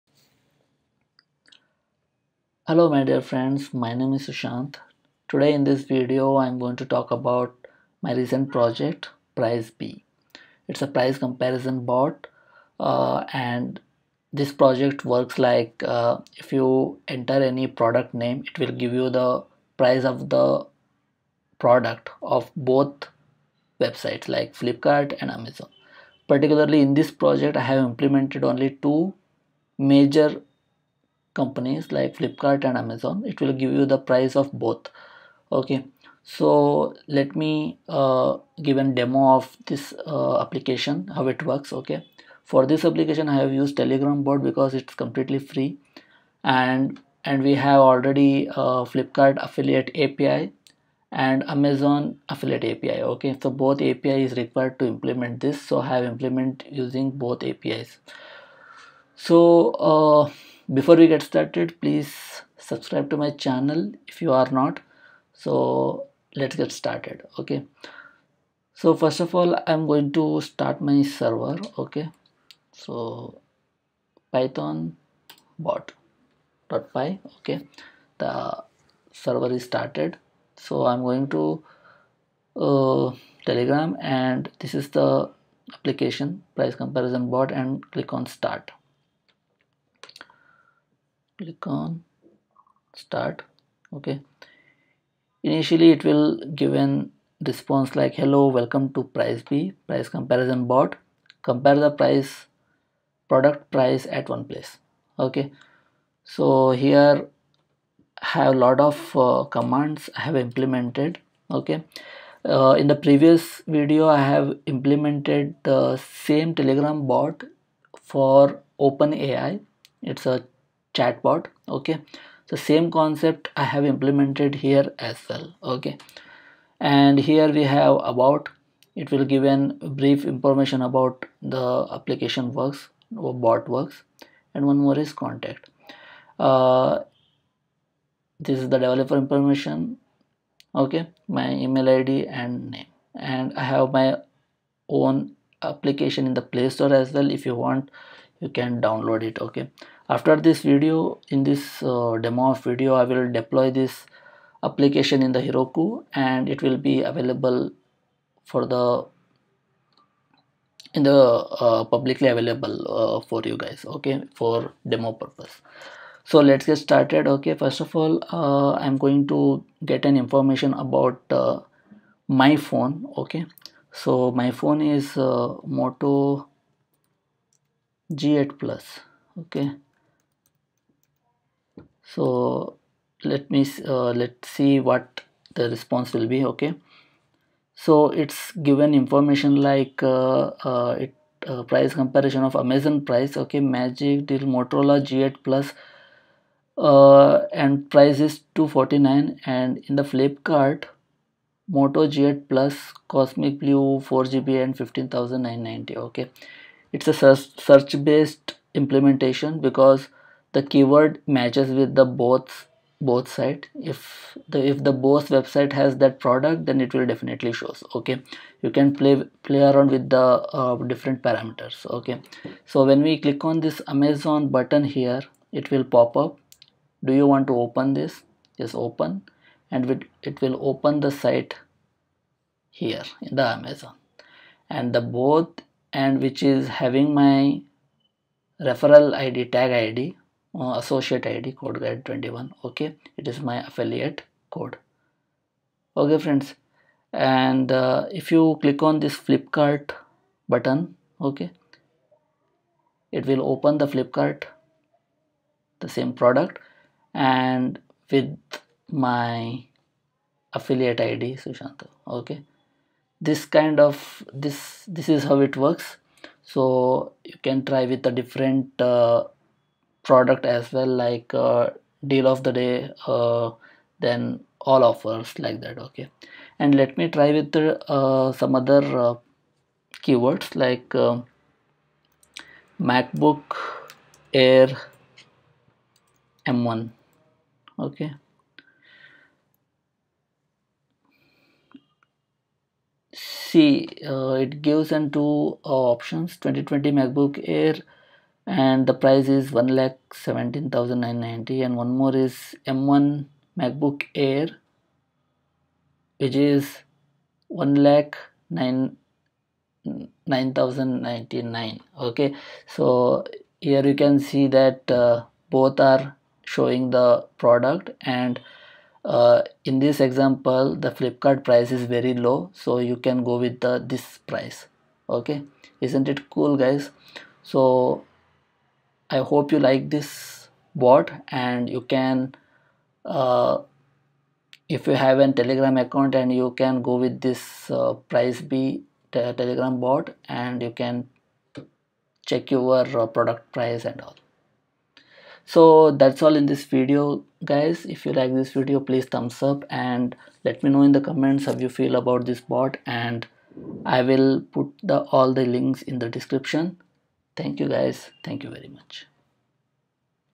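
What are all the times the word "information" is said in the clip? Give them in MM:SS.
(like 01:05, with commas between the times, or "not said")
02:10, 02:19, 02:50, 03:08.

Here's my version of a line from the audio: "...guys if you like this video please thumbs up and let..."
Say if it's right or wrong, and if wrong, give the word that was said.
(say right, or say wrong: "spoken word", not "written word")
right.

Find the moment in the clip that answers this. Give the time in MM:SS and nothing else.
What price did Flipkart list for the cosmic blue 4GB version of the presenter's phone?
03:24.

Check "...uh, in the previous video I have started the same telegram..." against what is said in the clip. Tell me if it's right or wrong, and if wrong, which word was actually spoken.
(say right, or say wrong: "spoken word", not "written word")
wrong: "implemented", not "started".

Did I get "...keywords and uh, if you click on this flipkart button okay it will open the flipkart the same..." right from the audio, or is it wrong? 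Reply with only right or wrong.
wrong.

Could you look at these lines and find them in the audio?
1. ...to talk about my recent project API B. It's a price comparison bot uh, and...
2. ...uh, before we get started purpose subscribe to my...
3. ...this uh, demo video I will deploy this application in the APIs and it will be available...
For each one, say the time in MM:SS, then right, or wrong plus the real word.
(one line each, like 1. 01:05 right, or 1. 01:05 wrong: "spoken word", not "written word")
1. 00:06 wrong: "Price", not "API"
2. 00:59 wrong: "please", not "purpose"
3. 02:31 wrong: "Heroku", not "APIs".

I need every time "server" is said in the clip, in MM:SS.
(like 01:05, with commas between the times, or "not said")
01:11, 01:19.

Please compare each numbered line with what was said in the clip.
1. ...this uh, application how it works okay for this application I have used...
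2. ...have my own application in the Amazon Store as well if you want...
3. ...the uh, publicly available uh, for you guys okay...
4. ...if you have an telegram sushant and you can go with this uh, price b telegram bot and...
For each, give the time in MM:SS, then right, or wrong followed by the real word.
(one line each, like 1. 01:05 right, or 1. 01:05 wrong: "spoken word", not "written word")
1. 00:39 right
2. 02:23 wrong: "Play", not "Amazon"
3. 02:41 right
4. 05:34 wrong: "account", not "sushant".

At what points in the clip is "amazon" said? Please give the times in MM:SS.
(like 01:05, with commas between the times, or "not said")
00:25, 00:32, 00:51, 03:12, 03:43, 03:53.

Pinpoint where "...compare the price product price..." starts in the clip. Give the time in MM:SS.
01:41.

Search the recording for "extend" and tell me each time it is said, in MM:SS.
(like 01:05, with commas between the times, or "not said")
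not said.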